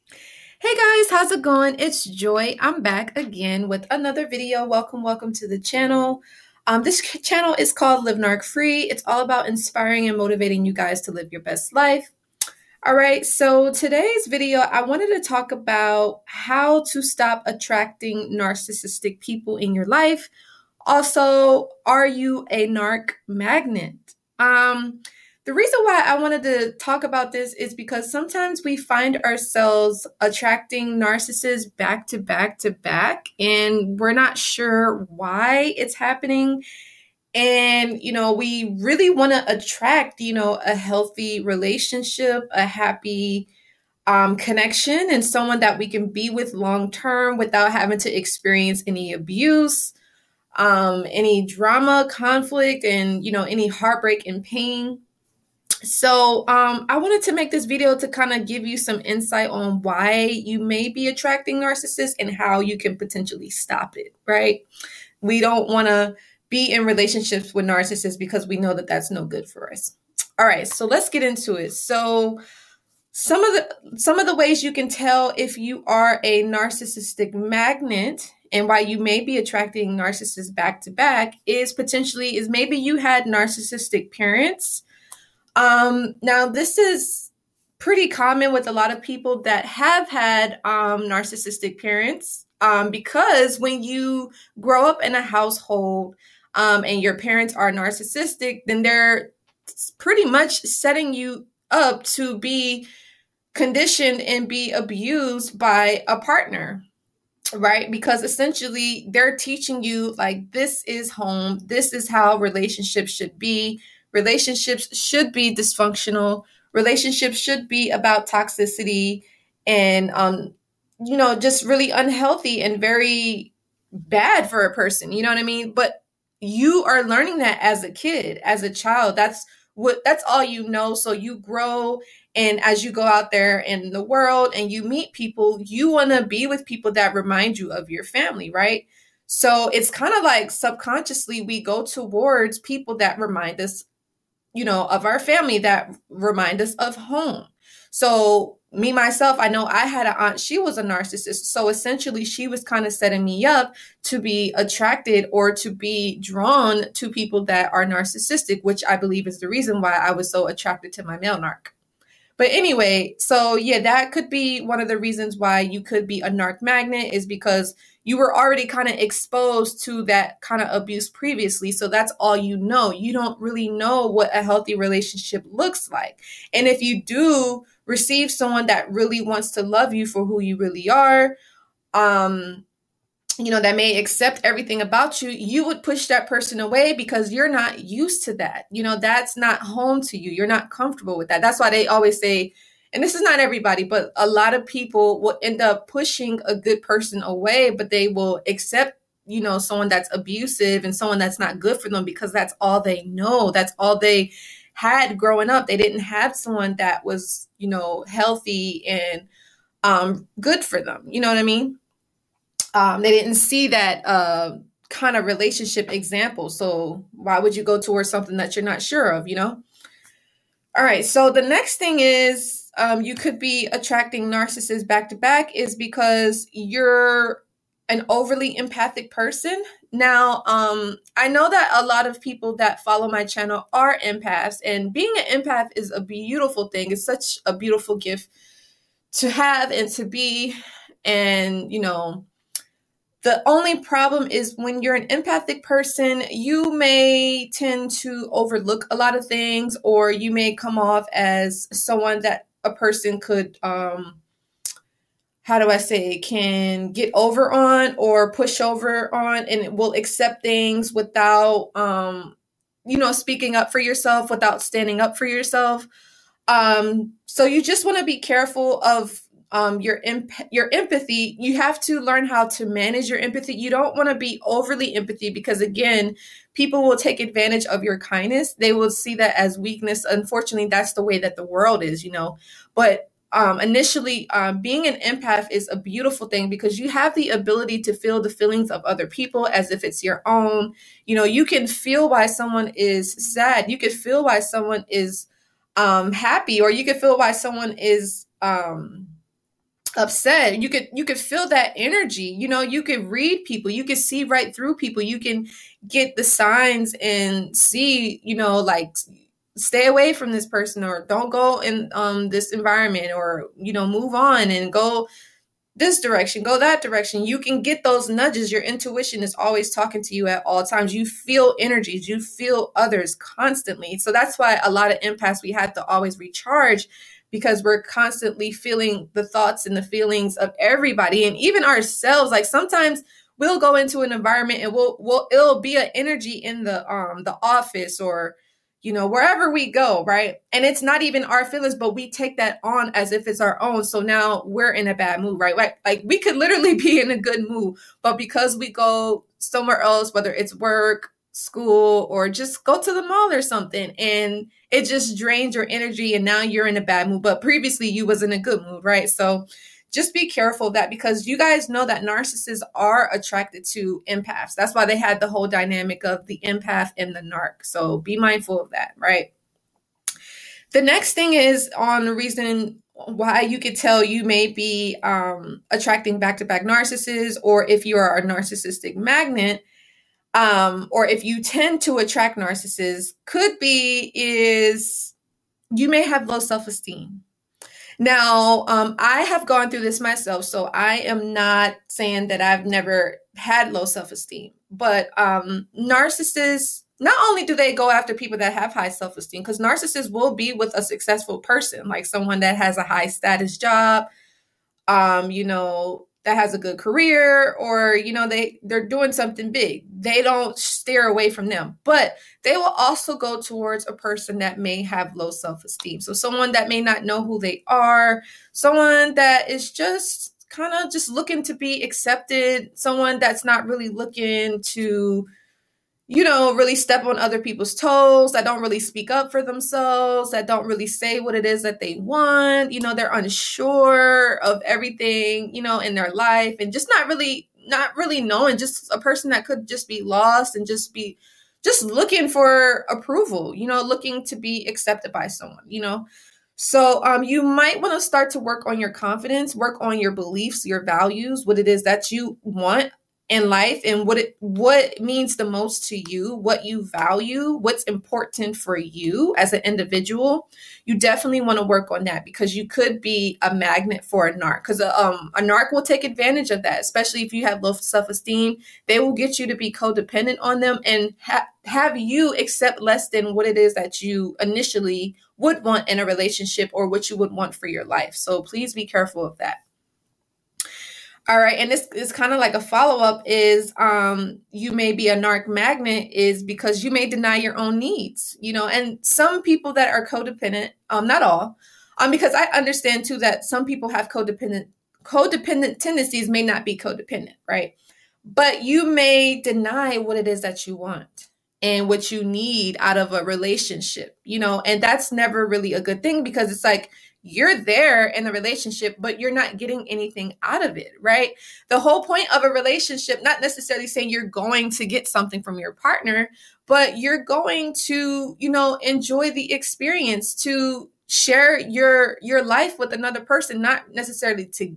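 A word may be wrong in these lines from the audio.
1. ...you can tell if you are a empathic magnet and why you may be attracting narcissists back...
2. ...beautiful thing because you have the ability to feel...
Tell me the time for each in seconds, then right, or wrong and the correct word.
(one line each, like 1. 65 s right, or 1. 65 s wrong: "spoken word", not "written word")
1. 74 s wrong: "narcissistic", not "empathic"
2. 285 s right.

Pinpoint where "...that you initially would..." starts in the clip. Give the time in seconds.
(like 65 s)
473 s.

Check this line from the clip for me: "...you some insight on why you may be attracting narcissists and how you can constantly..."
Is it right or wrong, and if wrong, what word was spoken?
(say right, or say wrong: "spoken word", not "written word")
wrong: "potentially", not "constantly".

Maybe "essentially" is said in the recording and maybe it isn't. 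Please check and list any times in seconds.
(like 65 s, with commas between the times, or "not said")
108 s, 151 s.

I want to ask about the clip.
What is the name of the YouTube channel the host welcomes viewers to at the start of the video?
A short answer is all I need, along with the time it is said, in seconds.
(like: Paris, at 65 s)
Live Narc Free, at 8 s.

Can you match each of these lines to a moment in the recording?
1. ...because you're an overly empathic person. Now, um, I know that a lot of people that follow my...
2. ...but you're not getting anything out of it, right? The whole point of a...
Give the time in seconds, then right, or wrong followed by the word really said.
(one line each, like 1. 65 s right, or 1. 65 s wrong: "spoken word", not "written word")
1. 225 s right
2. 508 s right.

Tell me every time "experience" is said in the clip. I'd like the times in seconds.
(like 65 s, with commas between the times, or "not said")
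48 s, 519 s.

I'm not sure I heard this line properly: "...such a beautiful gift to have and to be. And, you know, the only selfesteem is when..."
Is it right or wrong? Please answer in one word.
wrong.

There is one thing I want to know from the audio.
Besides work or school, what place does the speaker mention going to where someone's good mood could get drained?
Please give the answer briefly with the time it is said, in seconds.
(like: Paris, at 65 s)
The mall, at 352 s.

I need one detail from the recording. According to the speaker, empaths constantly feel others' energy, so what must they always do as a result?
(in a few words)
Recharge.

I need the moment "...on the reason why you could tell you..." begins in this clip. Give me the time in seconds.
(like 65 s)
371 s.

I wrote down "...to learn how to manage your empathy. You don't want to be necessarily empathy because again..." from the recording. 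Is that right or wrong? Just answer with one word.
wrong.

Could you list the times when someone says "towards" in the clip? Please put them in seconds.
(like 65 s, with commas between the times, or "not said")
141 s, 217 s, 413 s.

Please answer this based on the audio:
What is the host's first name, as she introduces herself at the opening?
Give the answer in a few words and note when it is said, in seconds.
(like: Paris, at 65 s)
Joy, at 2 s.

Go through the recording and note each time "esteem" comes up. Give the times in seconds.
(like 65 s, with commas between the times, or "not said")
386 s, 394 s, 399 s, 415 s, 468 s.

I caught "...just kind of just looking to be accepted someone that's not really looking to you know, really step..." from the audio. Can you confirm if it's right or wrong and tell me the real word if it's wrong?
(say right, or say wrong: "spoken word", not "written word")
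right.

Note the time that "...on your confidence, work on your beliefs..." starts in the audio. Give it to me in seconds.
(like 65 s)
448 s.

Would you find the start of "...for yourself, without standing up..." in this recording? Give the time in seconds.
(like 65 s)
263 s.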